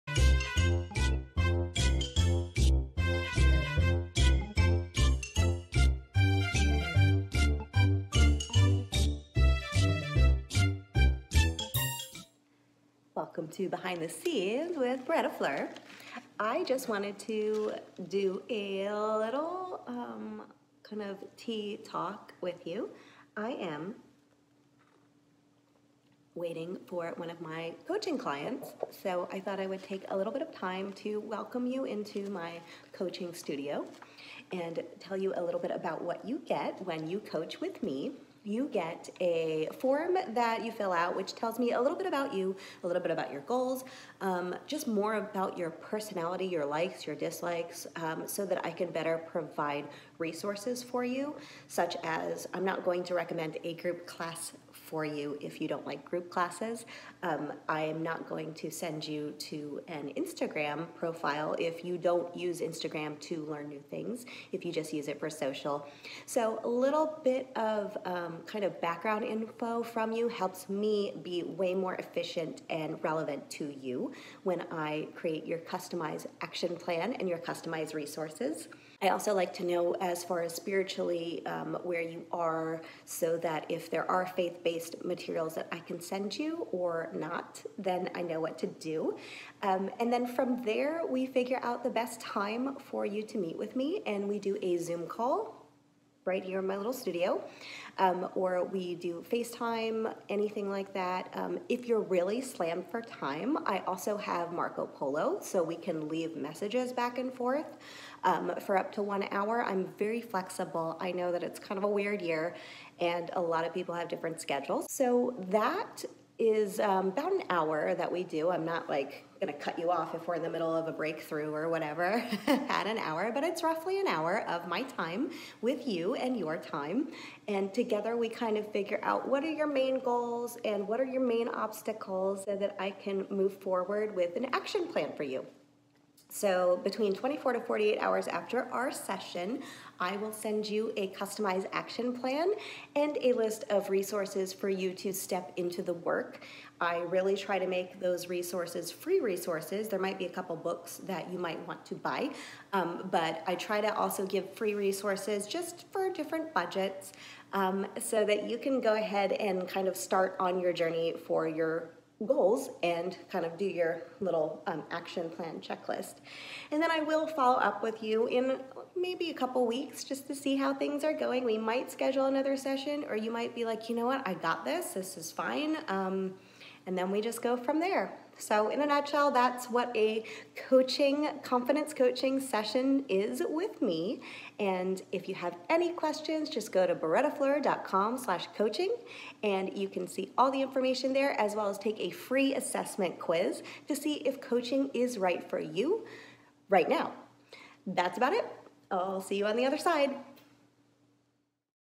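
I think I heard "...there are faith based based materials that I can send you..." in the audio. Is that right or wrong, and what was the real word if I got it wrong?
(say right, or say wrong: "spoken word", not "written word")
right.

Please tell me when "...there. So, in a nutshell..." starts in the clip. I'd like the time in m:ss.
2:57.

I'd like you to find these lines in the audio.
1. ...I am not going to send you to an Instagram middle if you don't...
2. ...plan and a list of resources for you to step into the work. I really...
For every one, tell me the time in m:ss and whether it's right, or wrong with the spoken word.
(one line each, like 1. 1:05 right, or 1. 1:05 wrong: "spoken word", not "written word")
1. 0:57 wrong: "profile", not "middle"
2. 2:22 right.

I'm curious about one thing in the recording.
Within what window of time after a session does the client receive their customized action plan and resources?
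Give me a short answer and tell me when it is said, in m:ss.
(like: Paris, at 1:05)
24 to 48 hours, at 2:17.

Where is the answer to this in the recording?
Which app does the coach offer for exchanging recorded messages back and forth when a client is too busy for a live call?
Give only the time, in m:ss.
1:44.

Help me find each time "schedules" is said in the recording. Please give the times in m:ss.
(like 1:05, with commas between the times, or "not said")
1:54, 2:51.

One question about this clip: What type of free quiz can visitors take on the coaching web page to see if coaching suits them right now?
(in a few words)
assessment quiz.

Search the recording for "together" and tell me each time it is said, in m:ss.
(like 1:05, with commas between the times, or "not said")
2:07.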